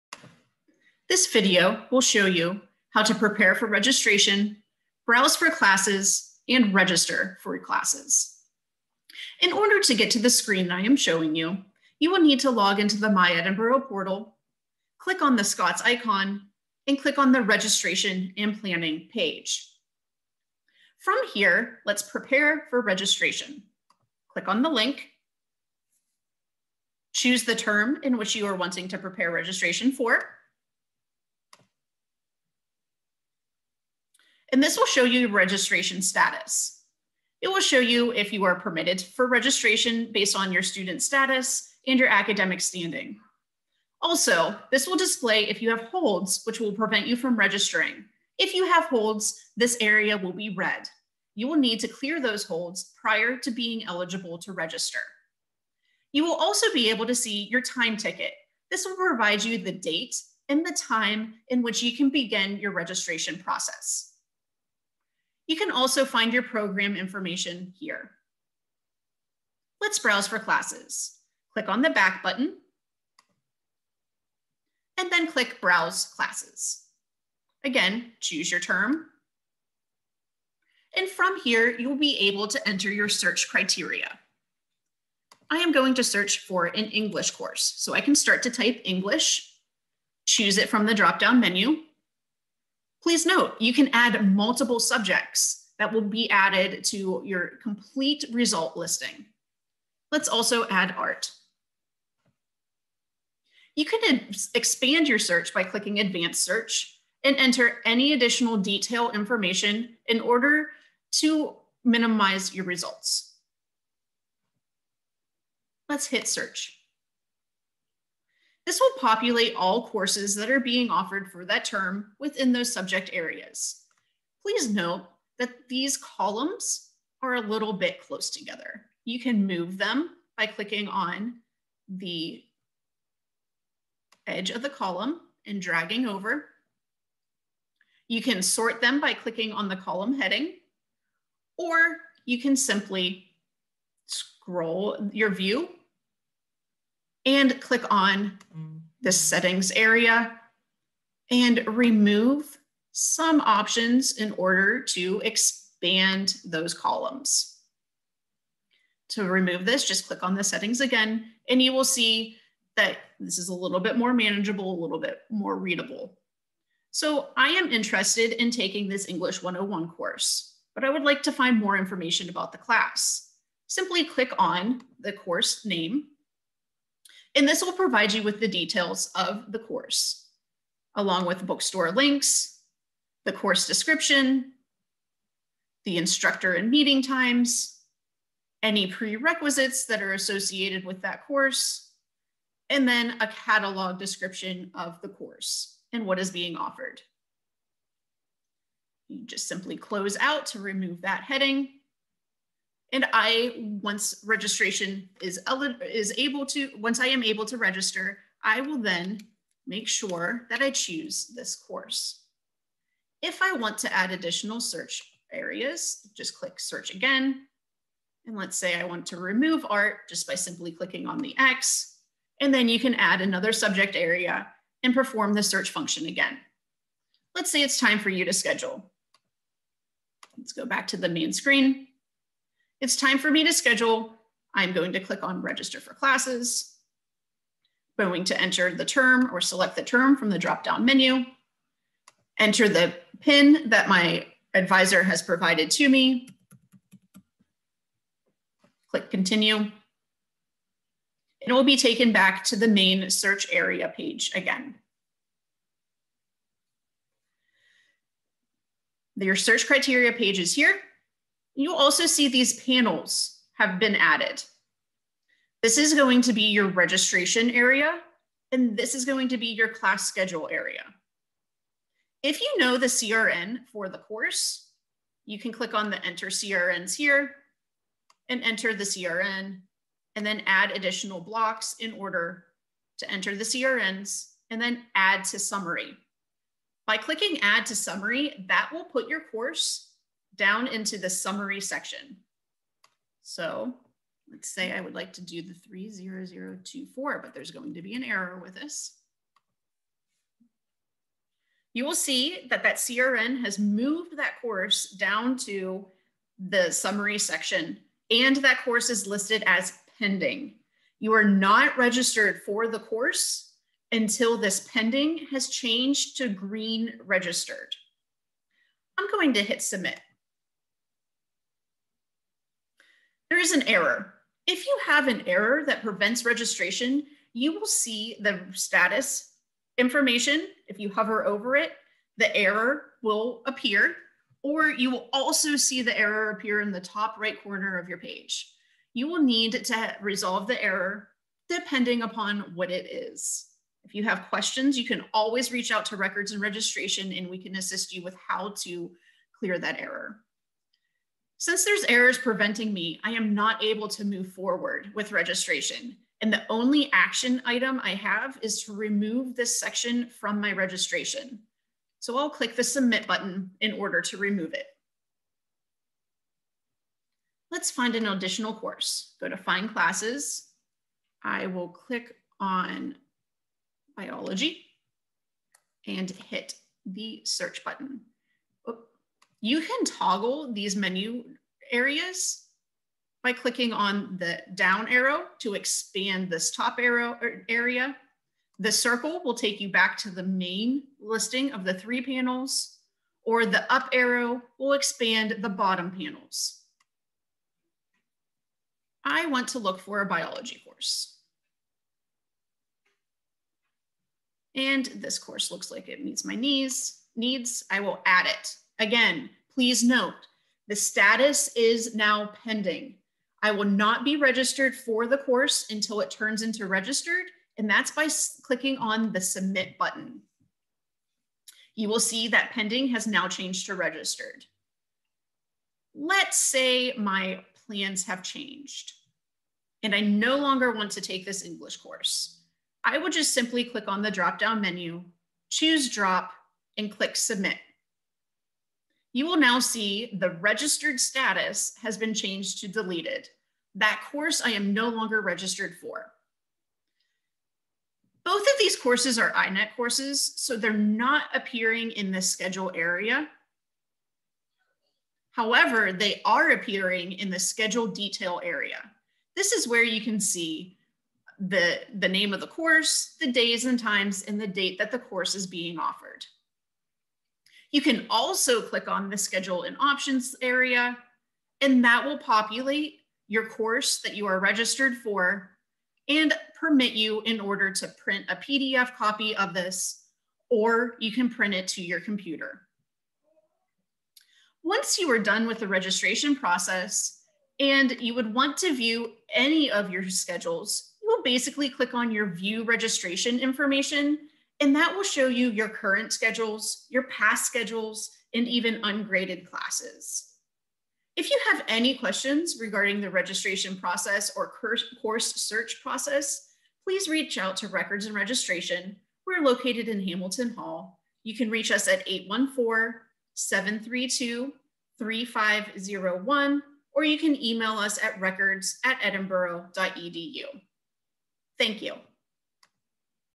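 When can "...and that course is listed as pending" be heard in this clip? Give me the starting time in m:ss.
5:08.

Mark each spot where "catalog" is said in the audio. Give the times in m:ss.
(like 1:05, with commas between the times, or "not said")
3:13.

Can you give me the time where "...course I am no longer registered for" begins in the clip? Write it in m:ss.
7:24.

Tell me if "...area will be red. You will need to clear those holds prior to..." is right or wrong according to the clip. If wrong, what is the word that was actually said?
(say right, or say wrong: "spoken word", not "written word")
right.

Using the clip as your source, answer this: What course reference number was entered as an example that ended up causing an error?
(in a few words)
30024.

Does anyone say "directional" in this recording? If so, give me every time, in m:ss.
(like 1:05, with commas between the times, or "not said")
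not said.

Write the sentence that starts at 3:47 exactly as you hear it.
Let's say it's time for you to schedule.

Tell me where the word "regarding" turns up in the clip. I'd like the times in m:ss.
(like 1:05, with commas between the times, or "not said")
8:22.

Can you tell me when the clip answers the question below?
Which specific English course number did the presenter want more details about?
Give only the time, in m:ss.
2:49.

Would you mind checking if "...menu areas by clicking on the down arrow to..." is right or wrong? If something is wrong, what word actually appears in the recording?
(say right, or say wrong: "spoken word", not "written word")
right.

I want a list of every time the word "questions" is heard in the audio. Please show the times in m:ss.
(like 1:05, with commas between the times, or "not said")
5:44, 8:21.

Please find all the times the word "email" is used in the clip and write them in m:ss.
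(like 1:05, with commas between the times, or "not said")
8:37.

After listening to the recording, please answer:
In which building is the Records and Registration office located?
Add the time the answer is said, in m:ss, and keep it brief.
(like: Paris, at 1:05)
Hamilton Hall, at 8:30.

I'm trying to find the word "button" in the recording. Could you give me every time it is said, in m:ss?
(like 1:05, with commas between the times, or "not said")
1:12, 6:03, 6:17, 6:59.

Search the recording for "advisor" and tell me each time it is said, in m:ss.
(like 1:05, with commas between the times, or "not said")
4:04.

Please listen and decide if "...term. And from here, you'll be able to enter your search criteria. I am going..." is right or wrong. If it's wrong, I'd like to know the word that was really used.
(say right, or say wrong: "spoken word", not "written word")
right.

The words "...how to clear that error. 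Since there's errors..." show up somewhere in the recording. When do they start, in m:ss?
5:48.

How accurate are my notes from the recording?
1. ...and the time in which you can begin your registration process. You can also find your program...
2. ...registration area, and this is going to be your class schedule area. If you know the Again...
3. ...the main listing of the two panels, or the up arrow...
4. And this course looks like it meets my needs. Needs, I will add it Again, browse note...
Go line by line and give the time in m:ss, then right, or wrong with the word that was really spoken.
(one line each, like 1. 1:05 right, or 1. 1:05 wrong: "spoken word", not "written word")
1. 1:00 right
2. 4:26 wrong: "CRN", not "Again"
3. 6:30 wrong: "three", not "two"
4. 6:44 wrong: "please", not "browse".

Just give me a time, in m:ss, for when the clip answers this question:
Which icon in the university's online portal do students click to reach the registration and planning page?
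0:15.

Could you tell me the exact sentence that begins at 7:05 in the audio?
Let's say my plans have changed and I no longer want to take this English course.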